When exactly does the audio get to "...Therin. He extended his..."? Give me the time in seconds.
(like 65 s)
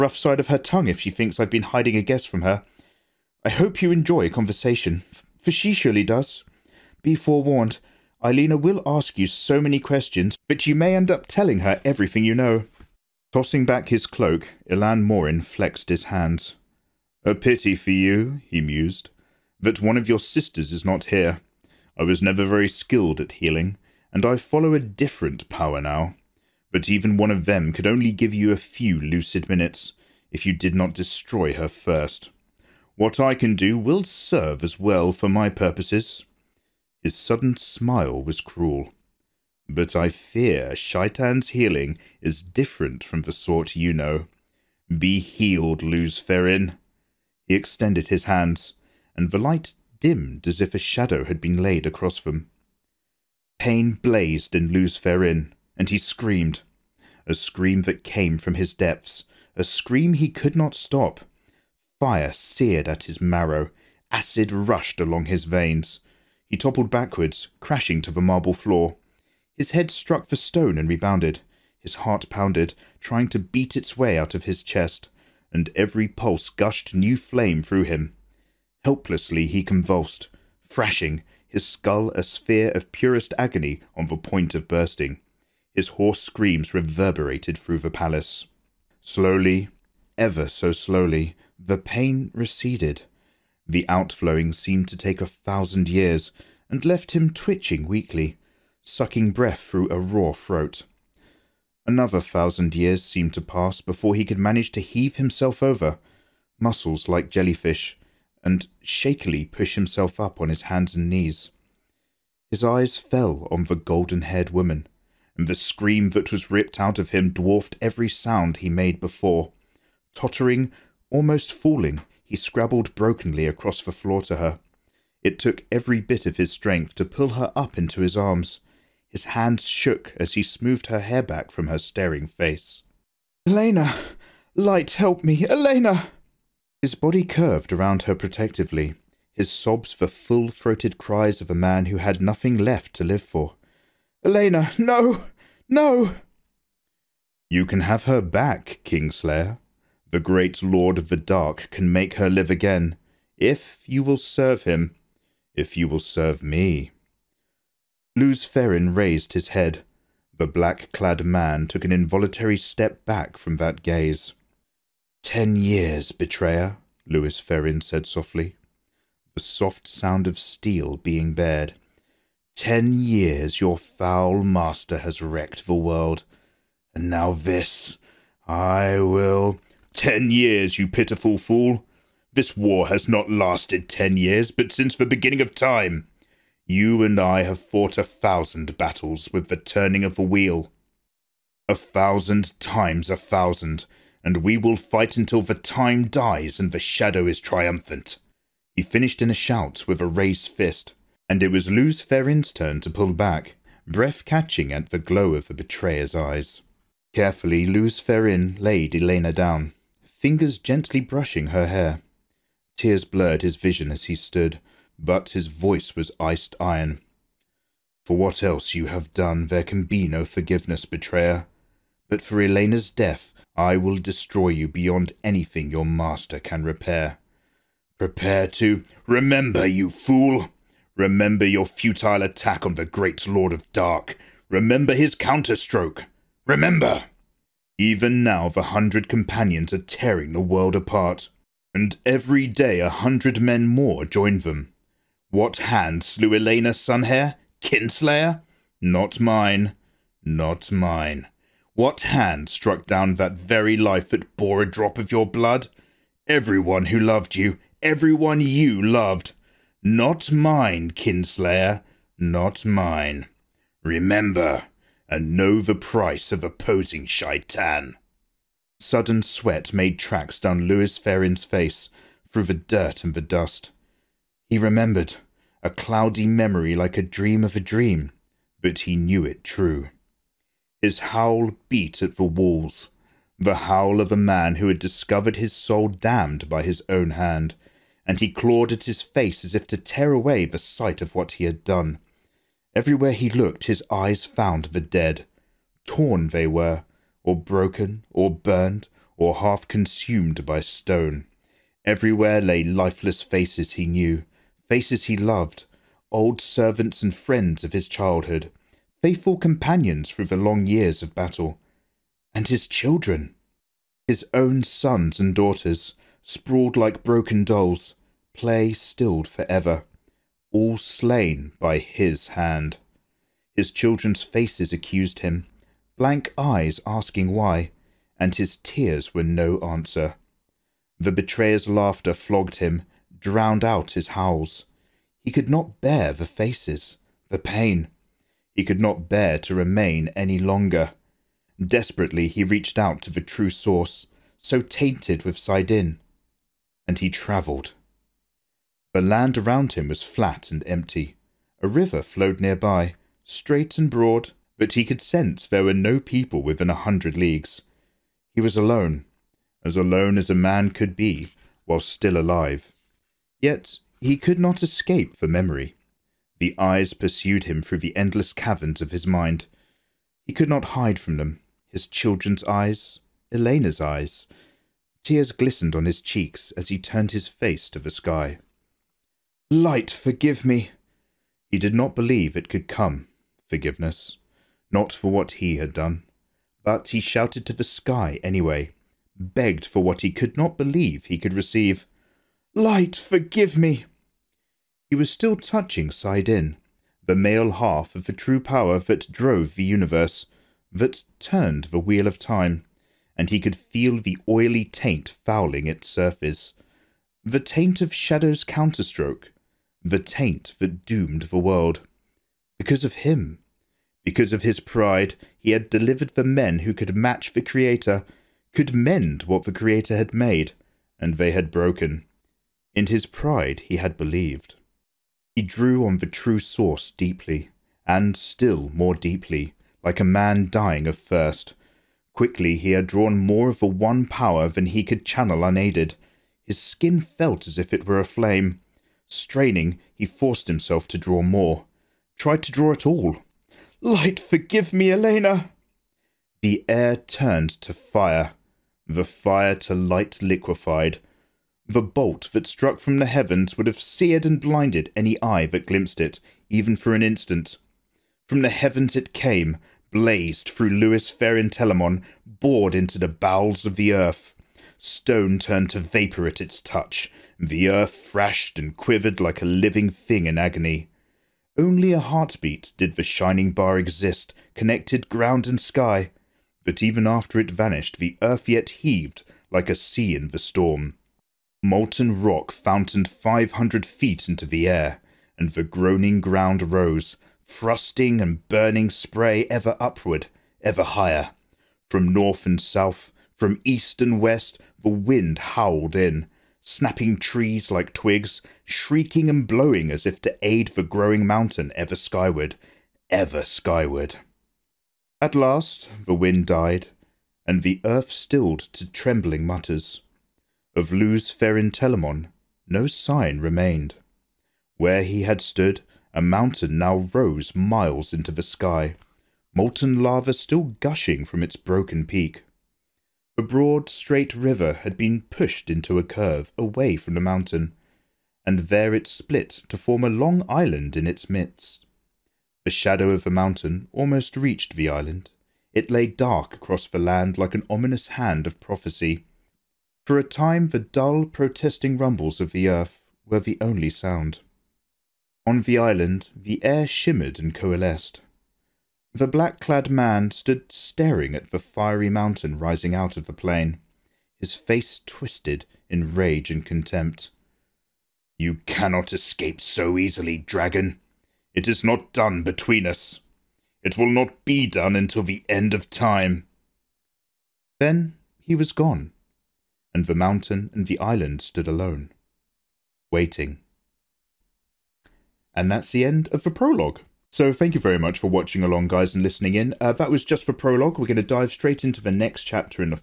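46 s.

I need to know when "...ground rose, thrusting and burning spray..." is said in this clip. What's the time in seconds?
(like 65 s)
486 s.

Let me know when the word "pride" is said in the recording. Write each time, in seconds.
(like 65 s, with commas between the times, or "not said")
414 s, 423 s.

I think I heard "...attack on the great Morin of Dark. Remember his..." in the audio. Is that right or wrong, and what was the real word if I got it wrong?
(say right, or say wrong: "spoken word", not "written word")
wrong: "Lord", not "Morin".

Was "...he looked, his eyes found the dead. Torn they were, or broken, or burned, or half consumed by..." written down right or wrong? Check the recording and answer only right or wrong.
right.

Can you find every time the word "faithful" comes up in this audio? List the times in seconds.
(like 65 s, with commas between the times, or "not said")
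309 s.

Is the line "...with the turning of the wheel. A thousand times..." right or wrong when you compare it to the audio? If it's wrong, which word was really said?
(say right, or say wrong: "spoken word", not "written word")
right.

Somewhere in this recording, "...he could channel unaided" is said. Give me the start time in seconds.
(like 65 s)
434 s.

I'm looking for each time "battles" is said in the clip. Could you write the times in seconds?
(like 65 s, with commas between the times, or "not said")
188 s, 311 s.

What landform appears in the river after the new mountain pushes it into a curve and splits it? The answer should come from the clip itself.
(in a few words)
long island.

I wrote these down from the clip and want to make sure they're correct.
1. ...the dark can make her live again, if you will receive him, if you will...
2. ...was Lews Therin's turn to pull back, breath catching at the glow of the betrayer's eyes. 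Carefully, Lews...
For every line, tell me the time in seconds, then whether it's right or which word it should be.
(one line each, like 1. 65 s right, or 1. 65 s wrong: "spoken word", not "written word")
1. 151 s wrong: "serve", not "receive"
2. 201 s right.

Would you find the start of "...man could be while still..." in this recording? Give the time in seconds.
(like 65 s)
360 s.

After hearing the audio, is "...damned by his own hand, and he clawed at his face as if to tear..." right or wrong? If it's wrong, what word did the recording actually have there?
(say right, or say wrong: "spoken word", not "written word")
right.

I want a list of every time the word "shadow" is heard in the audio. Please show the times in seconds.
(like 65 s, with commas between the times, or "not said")
50 s, 196 s, 407 s, 532 s.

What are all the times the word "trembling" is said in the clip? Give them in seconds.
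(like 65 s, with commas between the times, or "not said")
508 s.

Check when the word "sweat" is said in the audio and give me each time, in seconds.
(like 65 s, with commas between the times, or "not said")
269 s.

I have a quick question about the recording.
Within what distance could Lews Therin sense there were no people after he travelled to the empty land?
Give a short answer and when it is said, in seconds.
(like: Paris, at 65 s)
100 leagues, at 356 s.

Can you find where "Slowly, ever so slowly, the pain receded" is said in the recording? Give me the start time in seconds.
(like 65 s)
89 s.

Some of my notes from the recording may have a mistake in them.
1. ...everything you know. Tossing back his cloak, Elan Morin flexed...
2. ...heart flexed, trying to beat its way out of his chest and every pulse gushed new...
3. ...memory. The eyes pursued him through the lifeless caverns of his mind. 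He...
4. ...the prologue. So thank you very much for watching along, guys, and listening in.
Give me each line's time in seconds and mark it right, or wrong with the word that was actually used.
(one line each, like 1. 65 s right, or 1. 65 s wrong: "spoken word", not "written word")
1. 11 s right
2. 71 s wrong: "pounded", not "flexed"
3. 365 s wrong: "endless", not "lifeless"
4. 576 s right.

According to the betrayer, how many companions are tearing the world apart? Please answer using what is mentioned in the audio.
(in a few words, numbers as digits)
100.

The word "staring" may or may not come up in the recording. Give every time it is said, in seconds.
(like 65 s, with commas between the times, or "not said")
131 s, 550 s.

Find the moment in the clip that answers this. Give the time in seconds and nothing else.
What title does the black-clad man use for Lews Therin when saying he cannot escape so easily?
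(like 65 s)
560 s.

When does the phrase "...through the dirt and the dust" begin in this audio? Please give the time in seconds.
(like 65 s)
272 s.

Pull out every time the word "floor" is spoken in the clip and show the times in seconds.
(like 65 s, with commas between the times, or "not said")
68 s, 123 s.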